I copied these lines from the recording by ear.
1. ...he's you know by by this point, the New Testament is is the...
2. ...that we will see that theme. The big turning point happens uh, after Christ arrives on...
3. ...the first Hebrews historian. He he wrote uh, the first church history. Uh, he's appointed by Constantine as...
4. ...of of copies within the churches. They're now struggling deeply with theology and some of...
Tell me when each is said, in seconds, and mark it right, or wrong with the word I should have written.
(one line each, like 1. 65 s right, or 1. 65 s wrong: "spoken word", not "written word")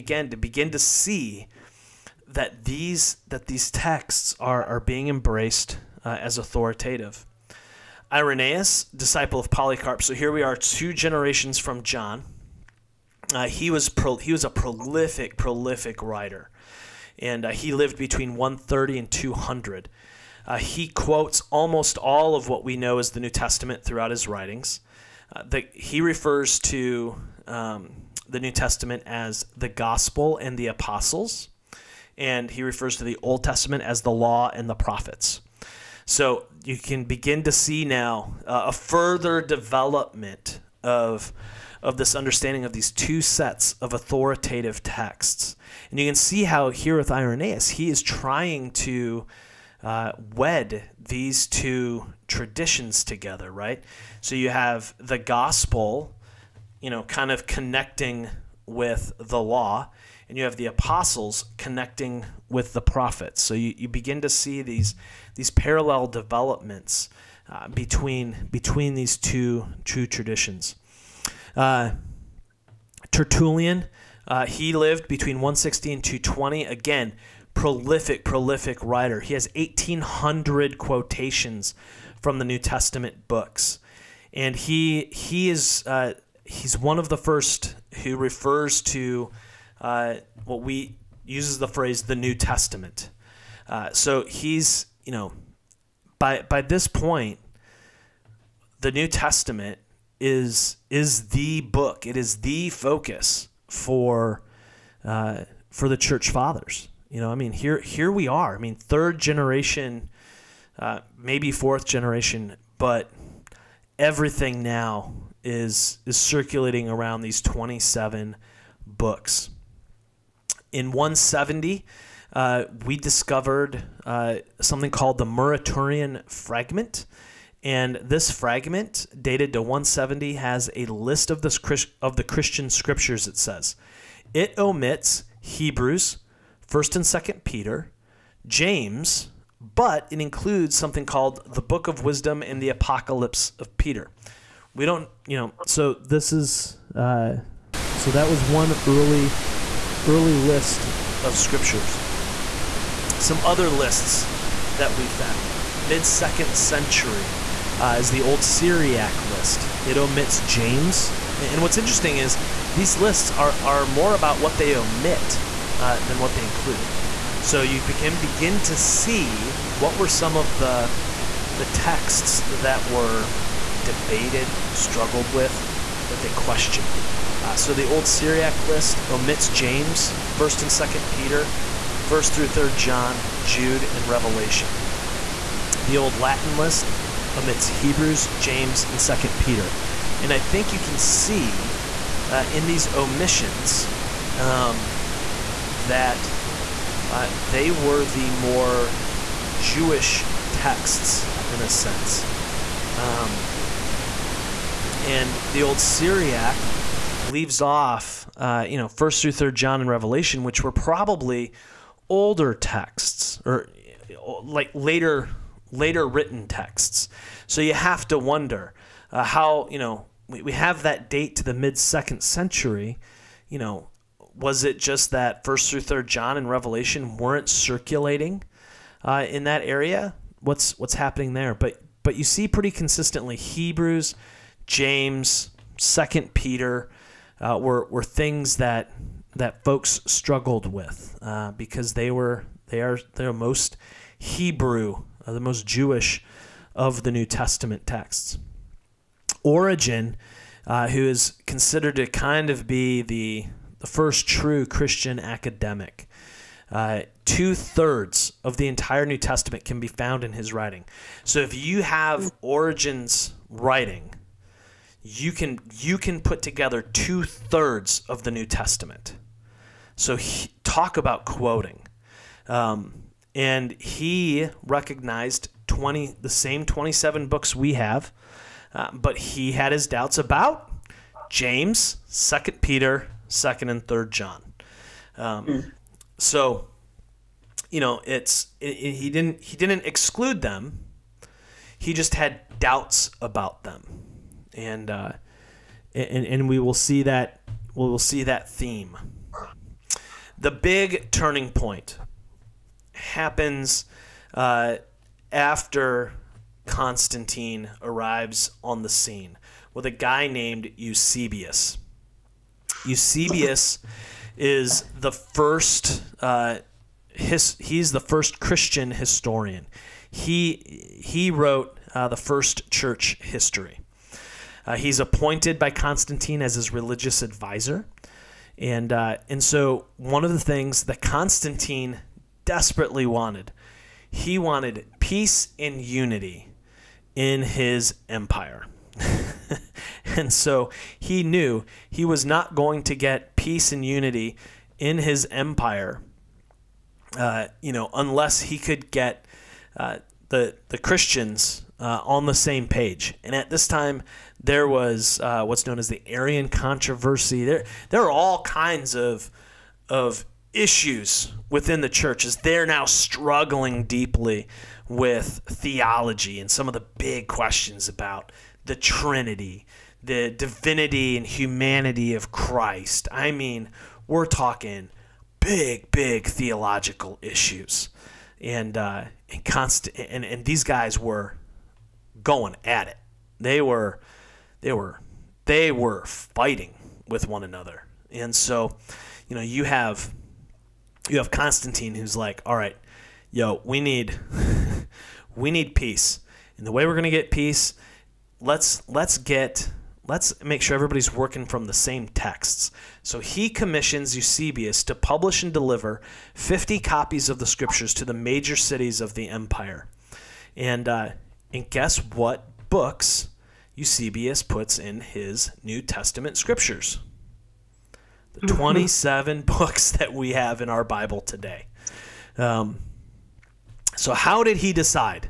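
1. 94 s right
2. 297 s wrong: "Constantine", not "Christ"
3. 317 s wrong: "Christian", not "Hebrews"
4. 358 s wrong: "issues", not "copies".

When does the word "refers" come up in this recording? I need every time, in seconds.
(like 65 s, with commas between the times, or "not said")
26 s, 32 s, 88 s.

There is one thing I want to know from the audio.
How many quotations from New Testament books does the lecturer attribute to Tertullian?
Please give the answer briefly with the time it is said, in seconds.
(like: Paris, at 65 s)
1,800, at 79 s.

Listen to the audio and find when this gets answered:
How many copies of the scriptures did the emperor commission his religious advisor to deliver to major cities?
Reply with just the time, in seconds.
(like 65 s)
406 s.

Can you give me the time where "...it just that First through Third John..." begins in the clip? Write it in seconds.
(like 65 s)
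224 s.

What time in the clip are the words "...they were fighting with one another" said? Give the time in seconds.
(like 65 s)
385 s.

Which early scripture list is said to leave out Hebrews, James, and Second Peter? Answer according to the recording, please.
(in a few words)
old Latin list.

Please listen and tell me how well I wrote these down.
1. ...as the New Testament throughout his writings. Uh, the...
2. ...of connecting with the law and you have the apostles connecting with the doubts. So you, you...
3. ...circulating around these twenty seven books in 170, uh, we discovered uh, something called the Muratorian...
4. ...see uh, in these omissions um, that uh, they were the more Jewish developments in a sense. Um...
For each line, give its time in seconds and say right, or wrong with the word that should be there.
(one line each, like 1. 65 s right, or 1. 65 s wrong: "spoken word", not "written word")
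1. 22 s right
2. 57 s wrong: "prophets", not "doubts"
3. 116 s right
4. 190 s wrong: "texts", not "developments".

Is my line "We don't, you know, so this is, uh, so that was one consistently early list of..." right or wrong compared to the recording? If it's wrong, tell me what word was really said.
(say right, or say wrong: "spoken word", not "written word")
wrong: "early", not "consistently".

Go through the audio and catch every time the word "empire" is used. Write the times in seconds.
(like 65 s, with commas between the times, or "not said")
338 s, 345 s, 409 s.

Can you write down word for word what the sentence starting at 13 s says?
Uh, he was pro, he was a prolific prolific writer, and uh, he lived between 130 and 200.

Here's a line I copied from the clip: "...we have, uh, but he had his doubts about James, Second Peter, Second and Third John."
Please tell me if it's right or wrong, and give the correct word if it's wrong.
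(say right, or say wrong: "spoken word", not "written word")
right.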